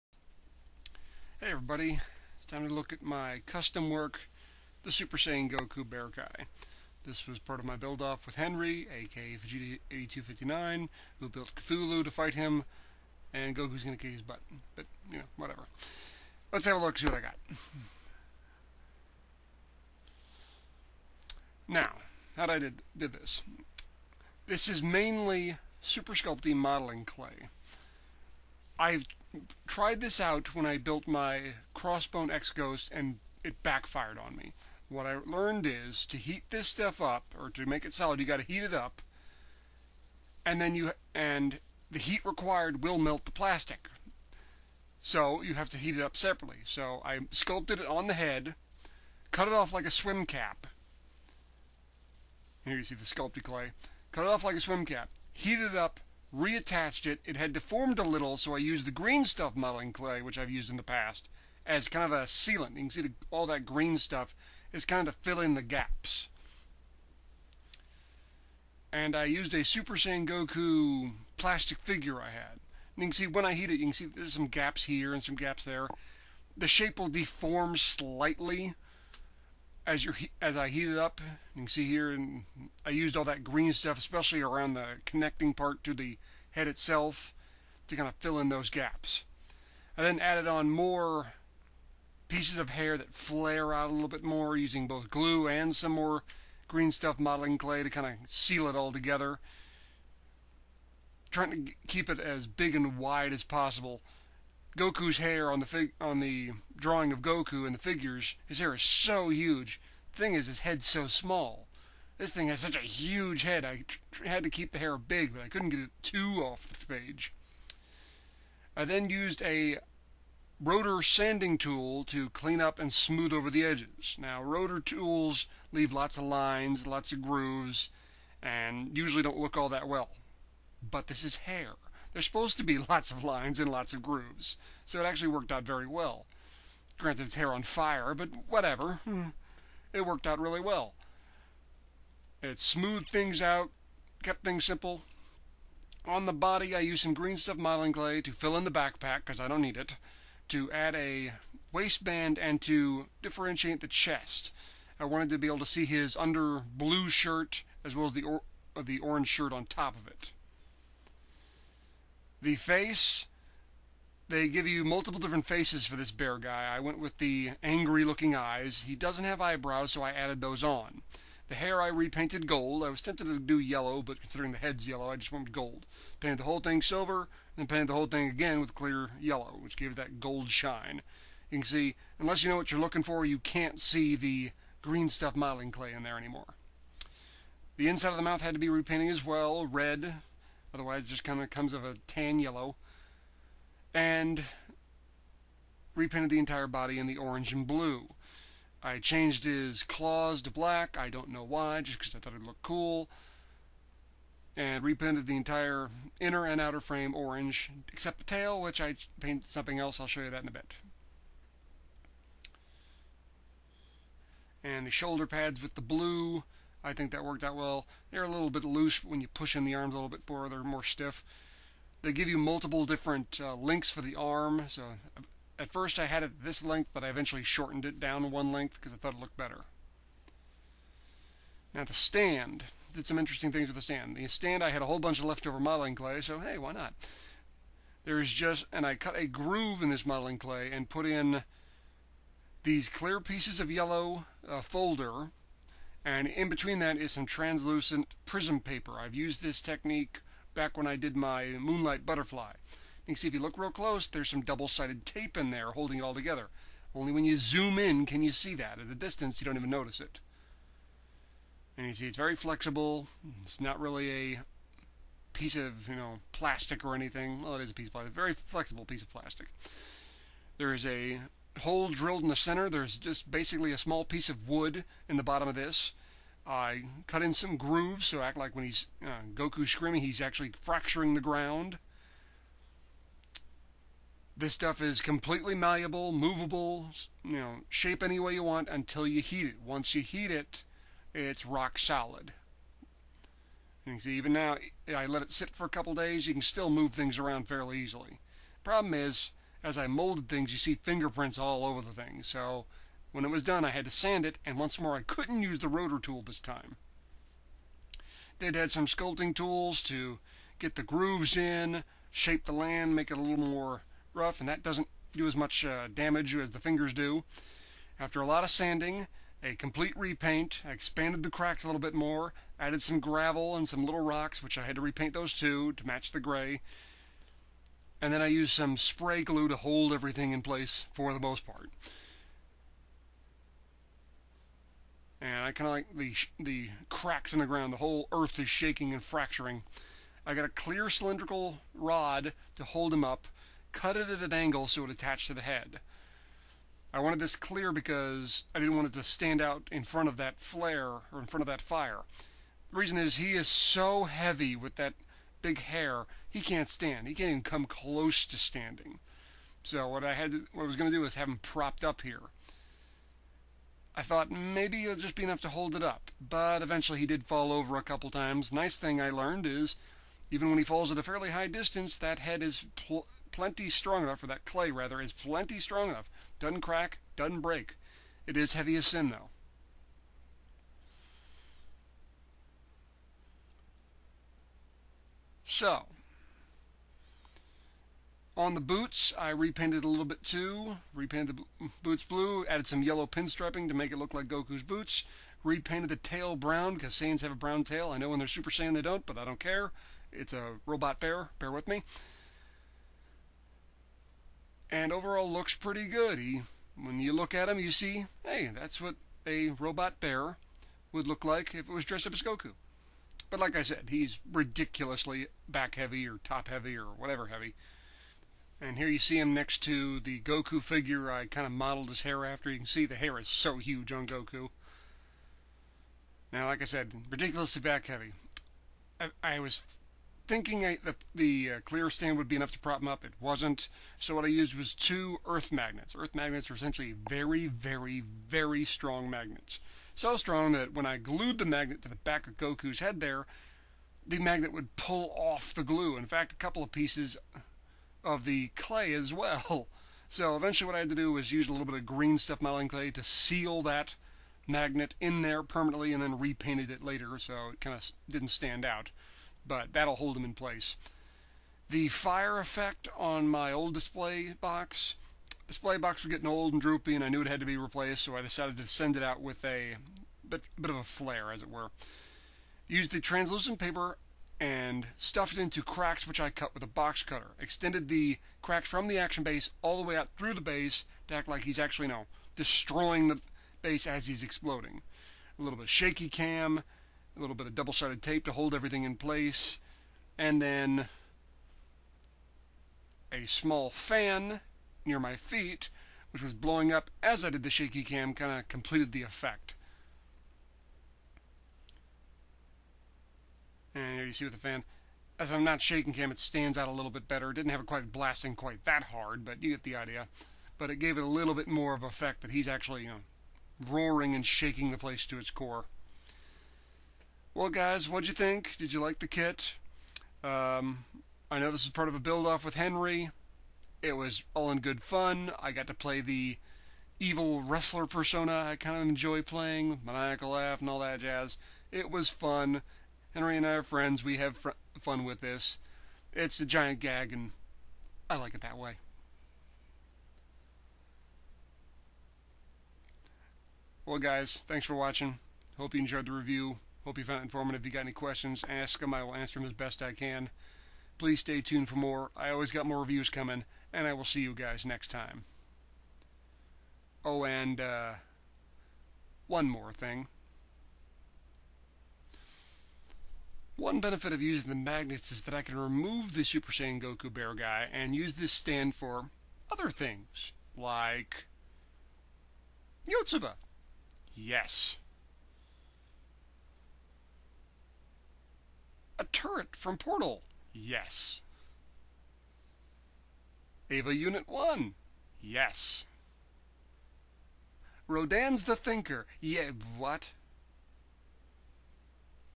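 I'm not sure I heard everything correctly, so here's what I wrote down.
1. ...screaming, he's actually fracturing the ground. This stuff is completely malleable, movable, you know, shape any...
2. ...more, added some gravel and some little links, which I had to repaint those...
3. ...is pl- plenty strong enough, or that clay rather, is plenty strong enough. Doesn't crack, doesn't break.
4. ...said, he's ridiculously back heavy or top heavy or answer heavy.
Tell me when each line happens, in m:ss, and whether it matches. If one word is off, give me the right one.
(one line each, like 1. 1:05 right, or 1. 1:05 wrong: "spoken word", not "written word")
1. 4:39 right
2. 5:21 wrong: "rocks", not "links"
3. 6:12 right
4. 6:53 wrong: "whatever", not "answer".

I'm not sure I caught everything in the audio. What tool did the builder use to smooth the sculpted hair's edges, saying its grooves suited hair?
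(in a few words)
rotor sanding tool.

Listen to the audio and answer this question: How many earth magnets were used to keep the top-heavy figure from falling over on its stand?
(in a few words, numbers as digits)
2.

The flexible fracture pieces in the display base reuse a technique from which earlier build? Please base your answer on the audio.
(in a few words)
Moonlight Butterfly.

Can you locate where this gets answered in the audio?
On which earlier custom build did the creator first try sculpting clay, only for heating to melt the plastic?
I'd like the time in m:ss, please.
0:31.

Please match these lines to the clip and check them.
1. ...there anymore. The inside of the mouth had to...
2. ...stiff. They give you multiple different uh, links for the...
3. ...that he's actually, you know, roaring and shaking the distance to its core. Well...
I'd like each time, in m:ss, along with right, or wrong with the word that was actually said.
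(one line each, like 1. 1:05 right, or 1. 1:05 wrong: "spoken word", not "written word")
1. 3:06 right
2. 3:40 right
3. 8:32 wrong: "place", not "distance".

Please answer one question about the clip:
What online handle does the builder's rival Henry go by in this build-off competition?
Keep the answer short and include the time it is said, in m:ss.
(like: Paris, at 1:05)
Vegeta 8259, at 0:09.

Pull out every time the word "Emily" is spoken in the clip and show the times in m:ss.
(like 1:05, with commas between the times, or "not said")
not said.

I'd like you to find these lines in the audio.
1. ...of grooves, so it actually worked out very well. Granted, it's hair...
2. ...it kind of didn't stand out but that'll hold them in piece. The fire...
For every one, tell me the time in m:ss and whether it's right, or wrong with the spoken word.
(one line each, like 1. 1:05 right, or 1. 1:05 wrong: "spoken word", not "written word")
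1. 2:13 right
2. 7:37 wrong: "place", not "piece".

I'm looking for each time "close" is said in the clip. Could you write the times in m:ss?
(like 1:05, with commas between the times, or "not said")
4:13, 5:57.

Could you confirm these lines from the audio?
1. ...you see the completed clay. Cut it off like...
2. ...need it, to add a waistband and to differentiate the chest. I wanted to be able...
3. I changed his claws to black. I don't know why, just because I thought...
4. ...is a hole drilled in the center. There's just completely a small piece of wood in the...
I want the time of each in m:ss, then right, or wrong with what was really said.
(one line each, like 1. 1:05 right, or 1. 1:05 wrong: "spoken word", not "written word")
1. 0:52 wrong: "sculpted", not "completed"
2. 2:29 right
3. 3:18 right
4. 4:30 wrong: "basically", not "completely".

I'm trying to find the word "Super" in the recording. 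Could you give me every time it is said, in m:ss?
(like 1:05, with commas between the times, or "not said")
0:04, 0:25, 1:09, 6:38, 9:26.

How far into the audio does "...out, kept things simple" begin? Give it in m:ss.
2:23.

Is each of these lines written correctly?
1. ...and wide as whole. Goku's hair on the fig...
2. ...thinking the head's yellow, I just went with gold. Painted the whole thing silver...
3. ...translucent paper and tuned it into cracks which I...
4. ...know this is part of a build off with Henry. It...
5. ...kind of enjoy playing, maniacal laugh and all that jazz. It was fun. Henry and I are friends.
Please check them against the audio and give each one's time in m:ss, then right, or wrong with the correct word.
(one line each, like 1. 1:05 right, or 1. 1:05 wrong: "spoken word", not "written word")
1. 1:42 wrong: "possible", not "whole"
2. 2:54 wrong: "considering", not "thinking"
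3. 7:52 wrong: "stuffed", not "tuned"
4. 8:41 right
5. 8:48 right.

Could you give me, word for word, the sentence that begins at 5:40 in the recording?
I got a clear cylindrical rod to hold him up, cut it at an angle so it attached to the head.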